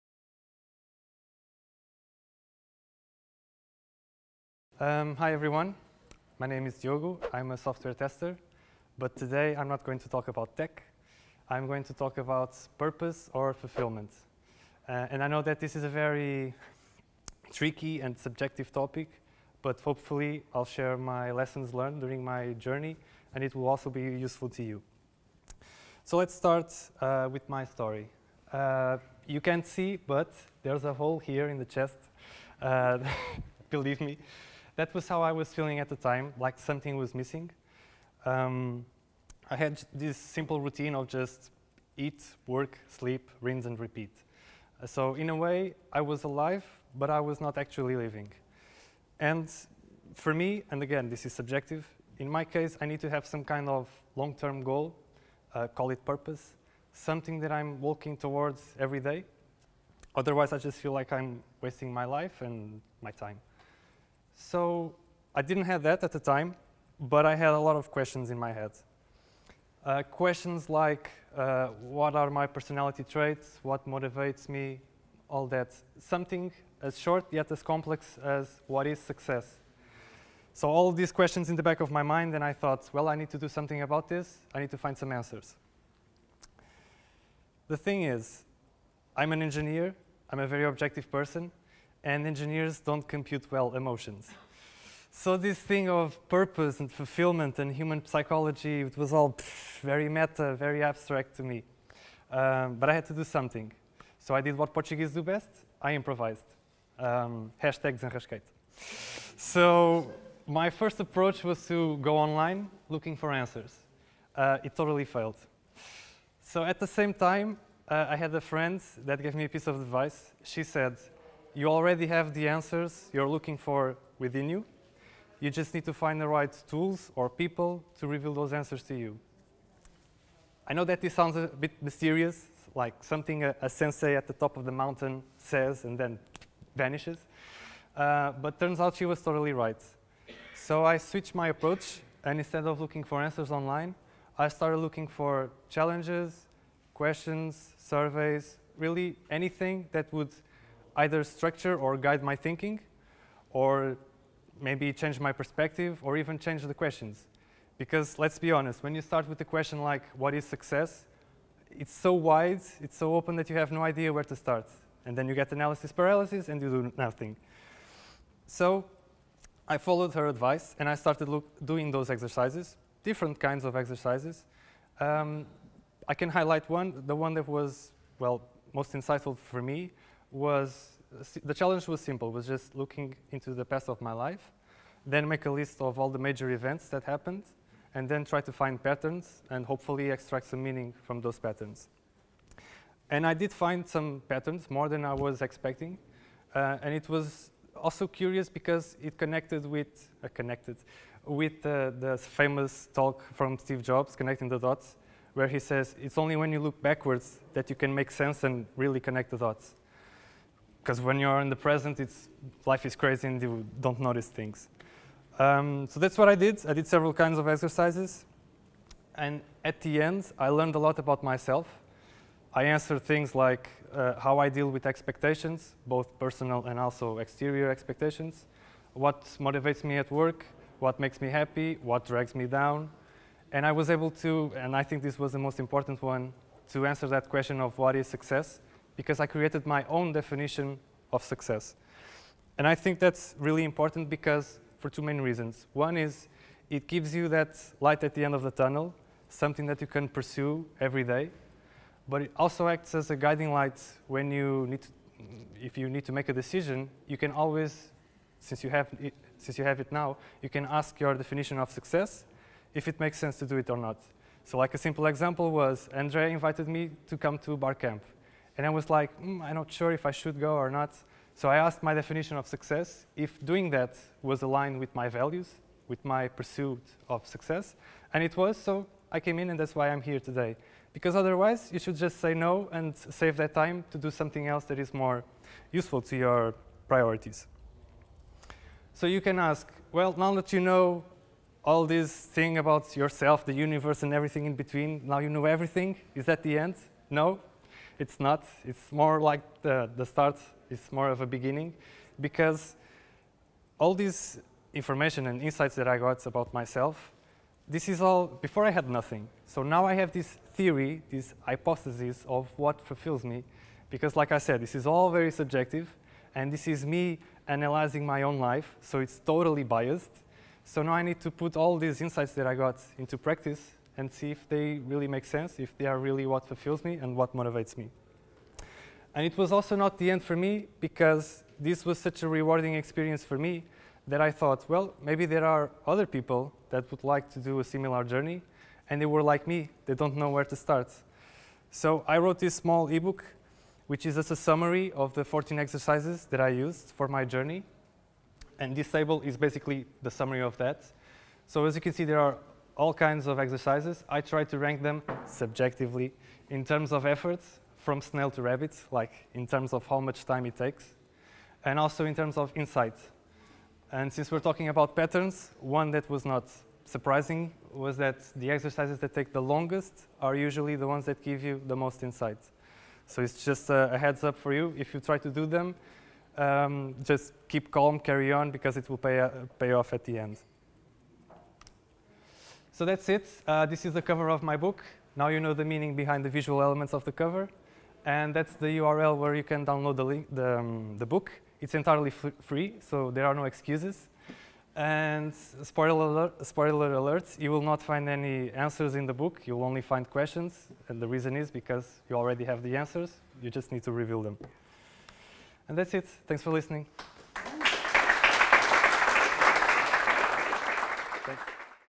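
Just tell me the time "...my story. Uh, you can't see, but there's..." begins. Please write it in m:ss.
0:27.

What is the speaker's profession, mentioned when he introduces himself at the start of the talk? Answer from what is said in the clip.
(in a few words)
Software tester.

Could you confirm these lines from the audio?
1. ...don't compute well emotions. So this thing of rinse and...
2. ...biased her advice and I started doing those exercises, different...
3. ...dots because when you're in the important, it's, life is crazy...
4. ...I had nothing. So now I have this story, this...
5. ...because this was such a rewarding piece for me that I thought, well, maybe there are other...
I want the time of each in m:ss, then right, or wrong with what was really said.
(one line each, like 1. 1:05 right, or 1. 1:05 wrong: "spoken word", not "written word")
1. 1:32 wrong: "purpose", not "rinse"
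2. 2:49 wrong: "followed", not "biased"
3. 3:29 wrong: "present", not "important"
4. 5:08 wrong: "theory", not "story"
5. 5:30 wrong: "experience", not "piece".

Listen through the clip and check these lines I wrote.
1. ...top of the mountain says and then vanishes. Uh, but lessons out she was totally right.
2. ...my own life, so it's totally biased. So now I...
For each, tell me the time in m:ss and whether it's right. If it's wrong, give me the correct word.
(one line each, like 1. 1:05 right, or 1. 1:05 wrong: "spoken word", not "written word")
1. 2:14 wrong: "turns", not "lessons"
2. 5:18 right.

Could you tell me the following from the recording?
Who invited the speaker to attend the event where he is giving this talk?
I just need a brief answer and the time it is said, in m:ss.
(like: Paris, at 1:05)
Andrea, at 4:25.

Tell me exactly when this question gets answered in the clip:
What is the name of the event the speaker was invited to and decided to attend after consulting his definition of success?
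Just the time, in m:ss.
4:27.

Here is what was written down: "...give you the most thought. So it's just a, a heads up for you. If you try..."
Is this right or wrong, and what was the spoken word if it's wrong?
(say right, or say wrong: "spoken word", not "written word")
wrong: "insight", not "thought".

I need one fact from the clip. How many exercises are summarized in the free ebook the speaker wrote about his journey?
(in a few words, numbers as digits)
14.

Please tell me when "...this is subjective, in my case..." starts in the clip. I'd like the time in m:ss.
0:51.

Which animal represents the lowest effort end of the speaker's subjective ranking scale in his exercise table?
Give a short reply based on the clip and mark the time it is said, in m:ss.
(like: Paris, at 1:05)
Snail, at 5:58.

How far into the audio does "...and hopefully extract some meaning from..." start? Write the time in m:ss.
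3:09.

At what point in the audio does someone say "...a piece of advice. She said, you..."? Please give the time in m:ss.
1:59.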